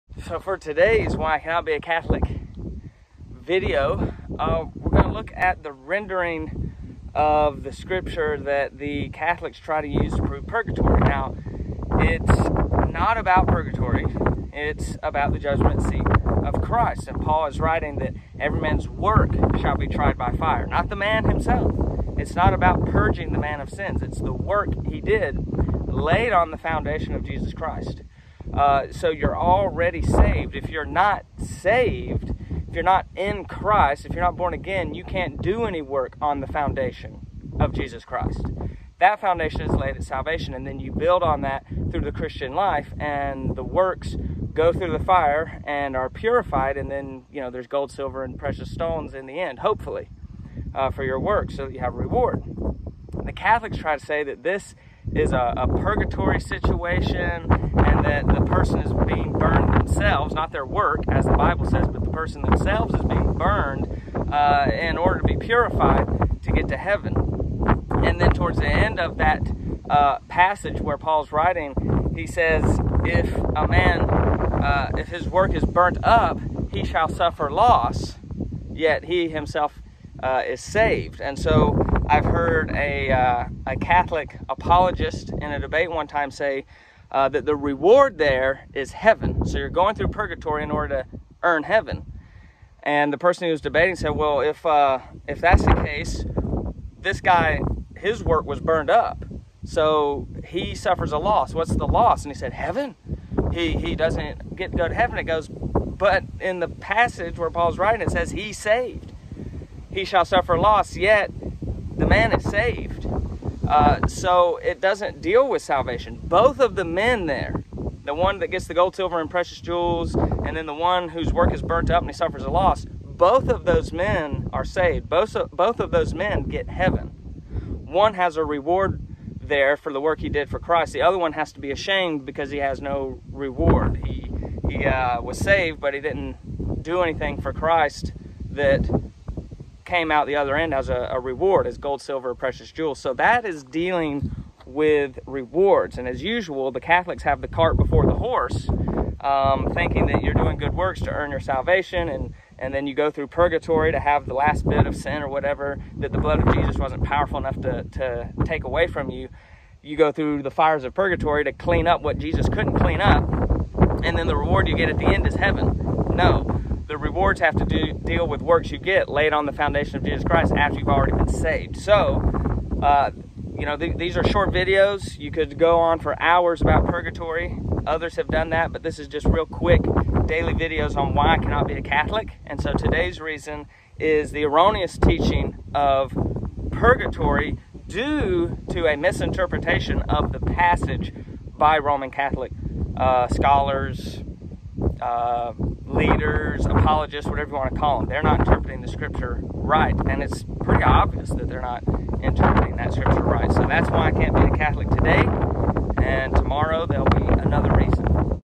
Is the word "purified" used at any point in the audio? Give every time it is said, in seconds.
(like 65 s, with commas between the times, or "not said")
46 s, 65 s.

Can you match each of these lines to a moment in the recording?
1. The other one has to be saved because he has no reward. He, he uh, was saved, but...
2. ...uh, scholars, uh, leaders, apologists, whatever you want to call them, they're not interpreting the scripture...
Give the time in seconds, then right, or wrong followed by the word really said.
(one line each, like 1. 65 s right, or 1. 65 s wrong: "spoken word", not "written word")
1. 130 s wrong: "ashamed", not "saved"
2. 192 s right.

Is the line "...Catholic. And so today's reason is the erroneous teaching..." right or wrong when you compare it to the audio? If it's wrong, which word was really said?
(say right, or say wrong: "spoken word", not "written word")
right.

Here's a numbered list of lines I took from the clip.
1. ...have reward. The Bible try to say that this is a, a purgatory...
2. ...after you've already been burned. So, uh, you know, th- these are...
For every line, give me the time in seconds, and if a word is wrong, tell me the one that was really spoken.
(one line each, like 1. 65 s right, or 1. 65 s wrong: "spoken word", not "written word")
1. 51 s wrong: "Catholics", not "Bible"
2. 170 s wrong: "saved", not "burned".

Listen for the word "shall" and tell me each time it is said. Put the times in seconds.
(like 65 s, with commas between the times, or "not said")
19 s, 76 s, 110 s.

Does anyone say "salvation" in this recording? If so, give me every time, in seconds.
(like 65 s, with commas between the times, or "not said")
40 s, 115 s, 151 s.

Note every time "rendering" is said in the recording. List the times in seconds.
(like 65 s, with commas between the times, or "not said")
5 s.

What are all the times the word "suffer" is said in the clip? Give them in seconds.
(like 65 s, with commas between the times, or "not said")
77 s, 100 s, 110 s, 122 s.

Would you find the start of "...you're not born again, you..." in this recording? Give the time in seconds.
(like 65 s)
34 s.